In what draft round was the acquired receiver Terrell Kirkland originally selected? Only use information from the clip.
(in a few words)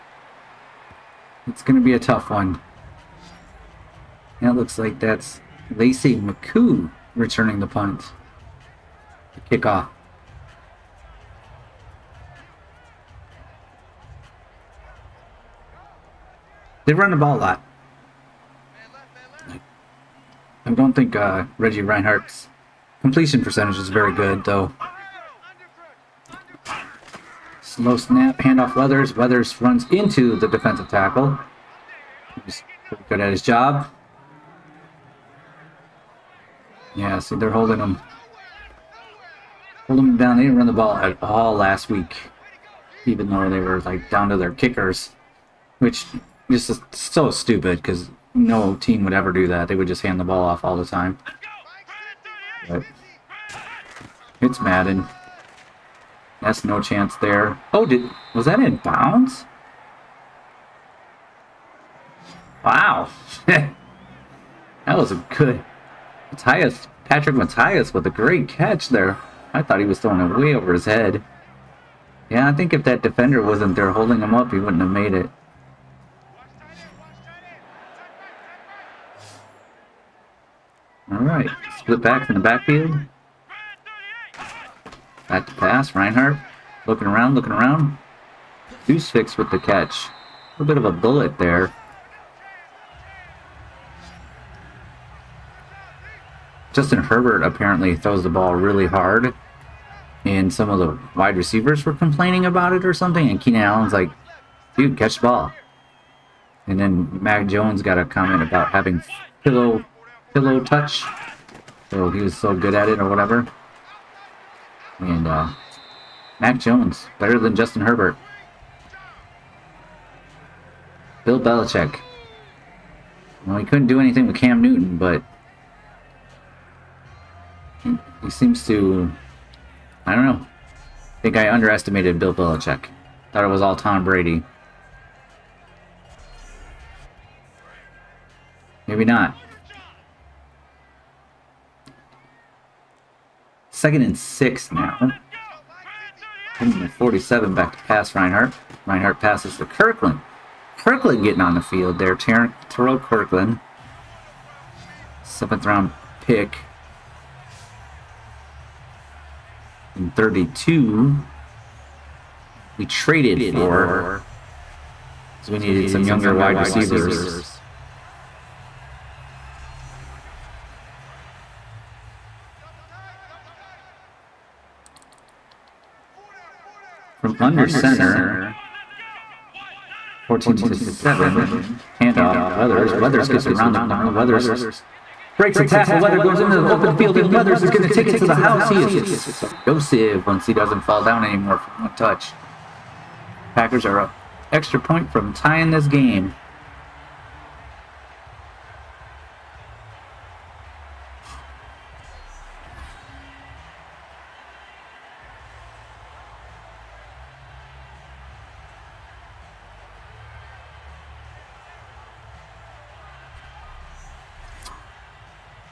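Seventh round.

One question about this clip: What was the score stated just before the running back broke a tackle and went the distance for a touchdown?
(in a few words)
14 to 7.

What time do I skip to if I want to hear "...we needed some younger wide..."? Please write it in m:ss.
2:45.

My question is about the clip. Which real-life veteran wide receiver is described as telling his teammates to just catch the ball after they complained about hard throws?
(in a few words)
Keenan Allen.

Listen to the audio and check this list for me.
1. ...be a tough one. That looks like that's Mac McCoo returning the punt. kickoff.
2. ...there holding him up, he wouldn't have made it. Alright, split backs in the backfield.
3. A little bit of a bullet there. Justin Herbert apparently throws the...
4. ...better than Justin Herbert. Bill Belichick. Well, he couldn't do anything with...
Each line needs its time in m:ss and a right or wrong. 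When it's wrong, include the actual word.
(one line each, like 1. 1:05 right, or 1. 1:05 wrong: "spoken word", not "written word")
1. 0:01 wrong: "Lacey", not "Mac"
2. 1:13 right
3. 1:30 right
4. 1:57 right.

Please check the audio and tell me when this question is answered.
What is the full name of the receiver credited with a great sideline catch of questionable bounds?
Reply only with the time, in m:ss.
1:07.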